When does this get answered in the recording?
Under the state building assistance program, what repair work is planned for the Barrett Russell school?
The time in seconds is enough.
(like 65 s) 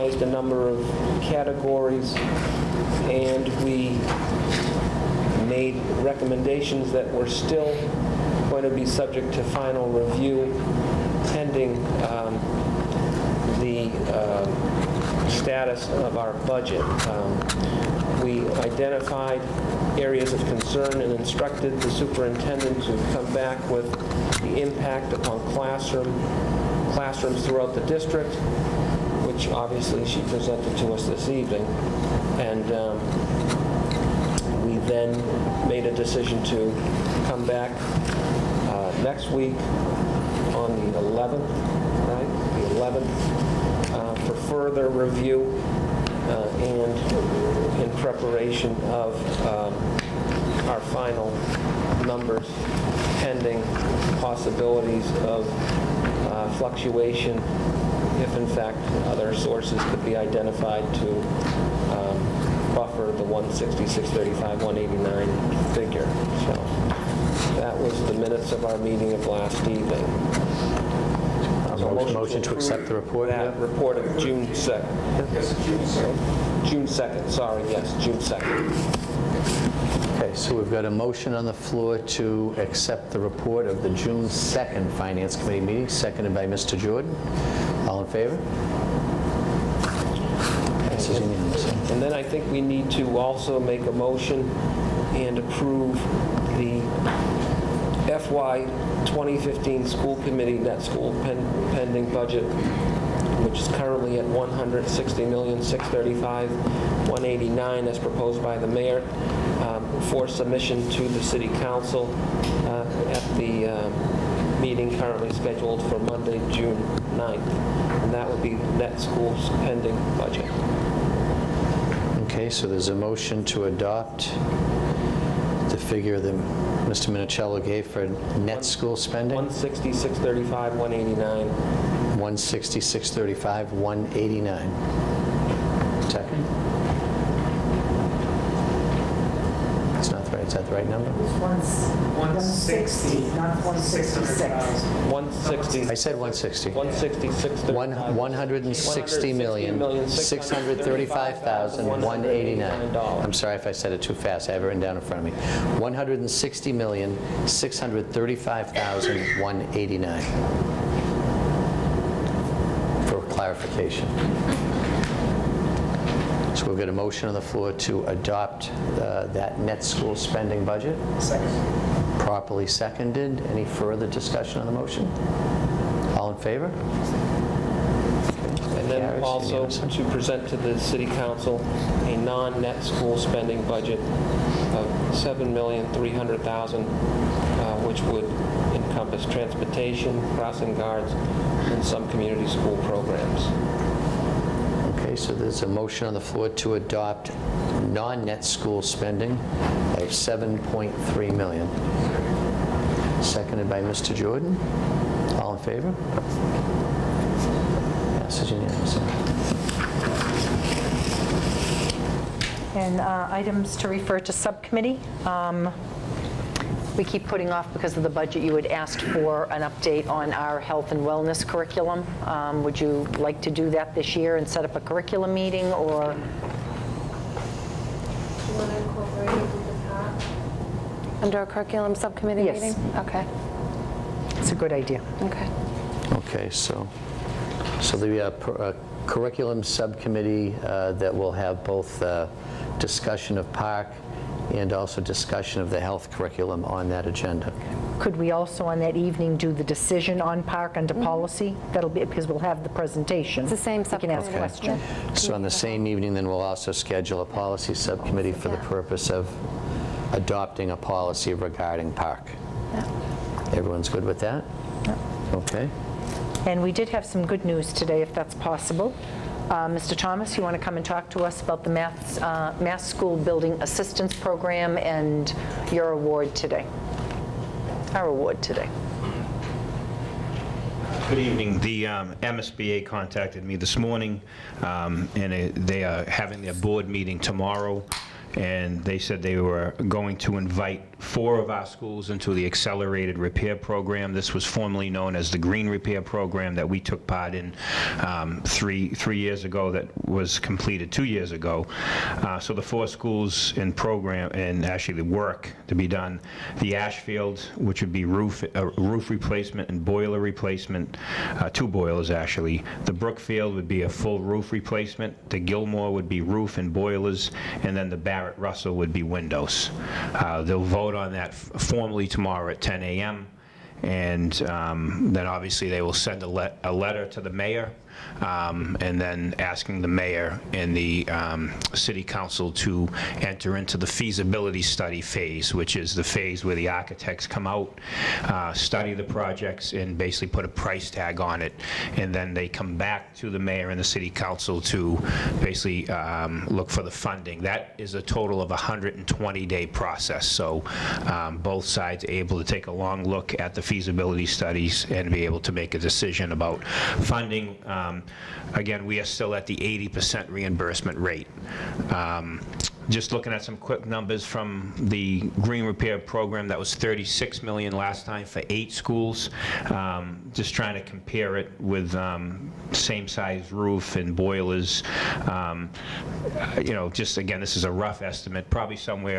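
319 s.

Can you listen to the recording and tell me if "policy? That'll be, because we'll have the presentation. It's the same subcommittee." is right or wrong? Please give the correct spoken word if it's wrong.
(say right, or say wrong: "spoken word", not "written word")
right.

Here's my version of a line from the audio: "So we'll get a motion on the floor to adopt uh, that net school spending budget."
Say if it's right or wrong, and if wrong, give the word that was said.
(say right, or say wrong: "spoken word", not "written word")
right.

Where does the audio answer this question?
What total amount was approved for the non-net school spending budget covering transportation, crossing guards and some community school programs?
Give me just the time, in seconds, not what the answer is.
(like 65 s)
185 s.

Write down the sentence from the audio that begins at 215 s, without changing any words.
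Um, we keep putting off because of the budget, you had asked for an update on our health and wellness curriculum.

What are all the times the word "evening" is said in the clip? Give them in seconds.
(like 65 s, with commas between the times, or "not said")
31 s, 69 s, 248 s, 255 s, 281 s.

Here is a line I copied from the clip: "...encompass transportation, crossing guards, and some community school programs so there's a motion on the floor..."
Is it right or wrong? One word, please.
right.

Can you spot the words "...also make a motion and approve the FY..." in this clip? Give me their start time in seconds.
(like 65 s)
93 s.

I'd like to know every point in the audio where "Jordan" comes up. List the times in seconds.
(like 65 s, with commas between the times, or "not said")
86 s, 204 s.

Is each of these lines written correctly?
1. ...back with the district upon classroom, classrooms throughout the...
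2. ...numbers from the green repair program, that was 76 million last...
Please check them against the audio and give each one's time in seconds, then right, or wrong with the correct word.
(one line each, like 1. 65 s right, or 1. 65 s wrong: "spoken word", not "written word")
1. 23 s wrong: "impact", not "district"
2. 363 s wrong: "36", not "76".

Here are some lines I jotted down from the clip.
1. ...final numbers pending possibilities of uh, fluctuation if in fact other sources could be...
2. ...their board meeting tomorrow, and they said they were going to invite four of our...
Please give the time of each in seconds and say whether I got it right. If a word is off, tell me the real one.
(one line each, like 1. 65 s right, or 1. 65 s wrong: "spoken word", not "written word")
1. 50 s right
2. 286 s right.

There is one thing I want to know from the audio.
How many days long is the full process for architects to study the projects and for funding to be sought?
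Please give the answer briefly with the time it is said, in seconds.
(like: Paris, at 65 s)
120, at 348 s.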